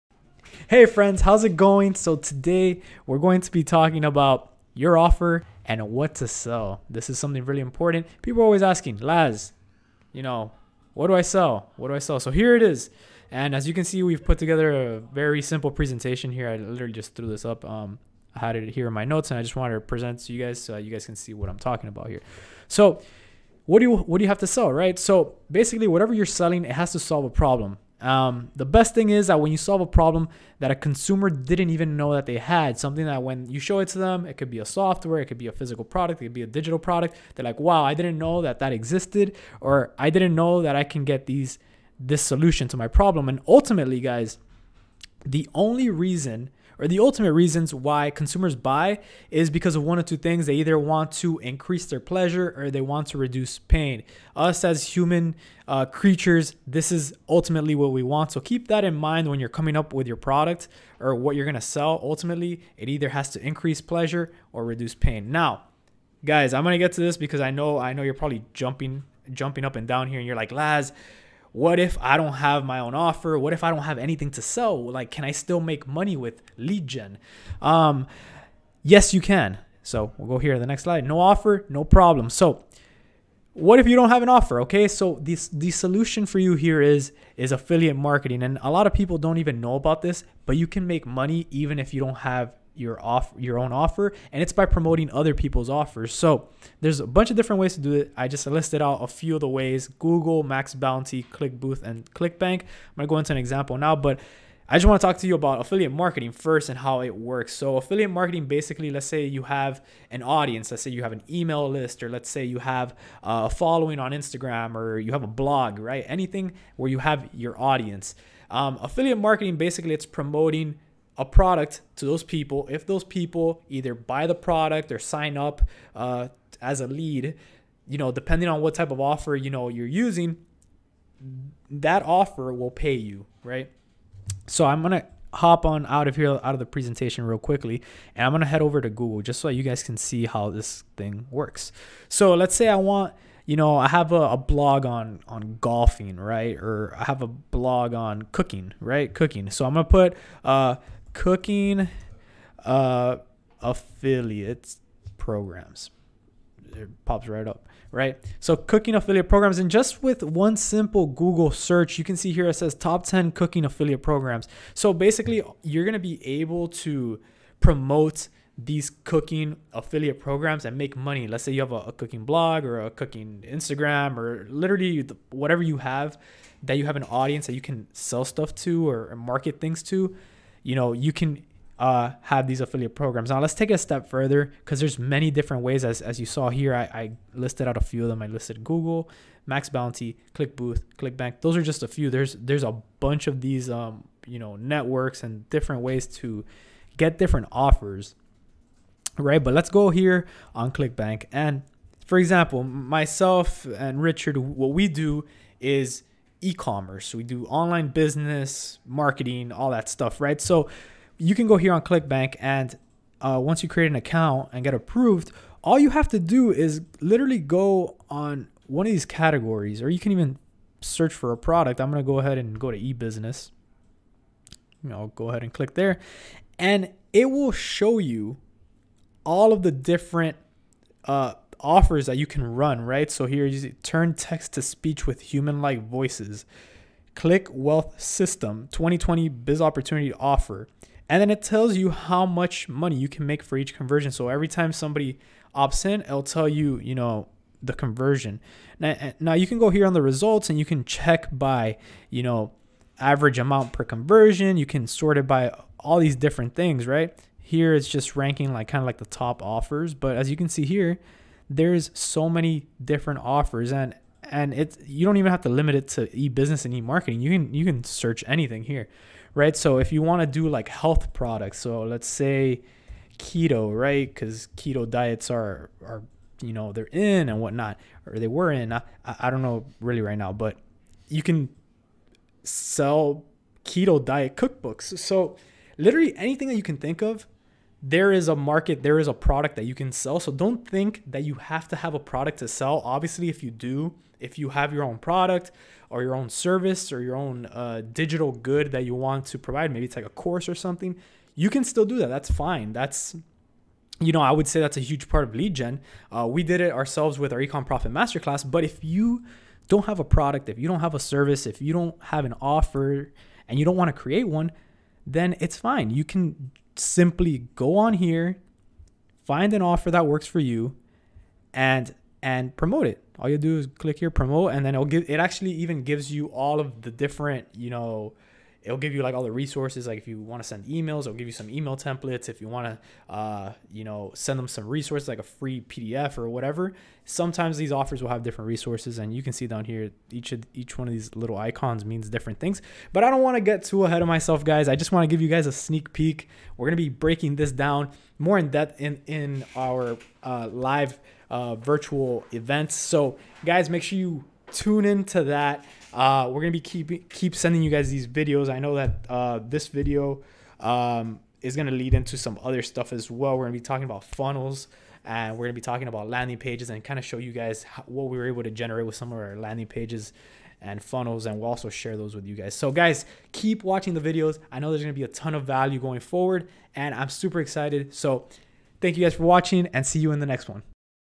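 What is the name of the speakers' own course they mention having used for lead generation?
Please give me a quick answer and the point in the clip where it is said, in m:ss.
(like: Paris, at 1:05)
Ecom Profit Masterclass, at 5:07.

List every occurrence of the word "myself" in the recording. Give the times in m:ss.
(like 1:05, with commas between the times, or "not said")
3:22, 5:44.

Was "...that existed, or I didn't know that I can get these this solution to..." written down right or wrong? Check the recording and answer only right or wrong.
right.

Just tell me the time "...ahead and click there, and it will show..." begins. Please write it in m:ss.
3:45.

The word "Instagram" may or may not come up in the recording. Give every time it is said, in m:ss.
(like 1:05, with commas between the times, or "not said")
1:54, 2:53.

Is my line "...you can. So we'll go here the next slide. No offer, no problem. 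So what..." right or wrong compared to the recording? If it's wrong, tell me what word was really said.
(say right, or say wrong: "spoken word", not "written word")
right.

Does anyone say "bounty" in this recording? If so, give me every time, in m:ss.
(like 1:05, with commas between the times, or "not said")
1:40, 3:09.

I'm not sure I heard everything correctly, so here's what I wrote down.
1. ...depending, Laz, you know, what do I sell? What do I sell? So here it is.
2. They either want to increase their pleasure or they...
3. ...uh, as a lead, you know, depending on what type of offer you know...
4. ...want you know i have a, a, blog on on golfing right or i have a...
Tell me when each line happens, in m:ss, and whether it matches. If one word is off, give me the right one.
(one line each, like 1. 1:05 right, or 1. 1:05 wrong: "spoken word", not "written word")
1. 0:08 wrong: "asking", not "depending"
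2. 0:50 right
3. 2:05 right
4. 2:22 right.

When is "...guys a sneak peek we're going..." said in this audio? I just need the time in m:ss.
5:45.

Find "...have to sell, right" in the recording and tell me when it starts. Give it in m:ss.
0:24.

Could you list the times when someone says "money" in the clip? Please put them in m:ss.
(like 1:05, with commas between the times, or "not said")
1:15, 1:31, 2:50, 4:02.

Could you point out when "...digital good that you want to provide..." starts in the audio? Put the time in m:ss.
4:57.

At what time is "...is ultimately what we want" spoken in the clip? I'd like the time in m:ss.
0:56.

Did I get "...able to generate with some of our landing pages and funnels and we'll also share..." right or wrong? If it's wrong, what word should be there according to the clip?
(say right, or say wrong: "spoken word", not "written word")
right.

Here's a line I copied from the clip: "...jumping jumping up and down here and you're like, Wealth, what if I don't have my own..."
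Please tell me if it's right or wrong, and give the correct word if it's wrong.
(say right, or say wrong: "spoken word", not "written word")
wrong: "Laz", not "Wealth".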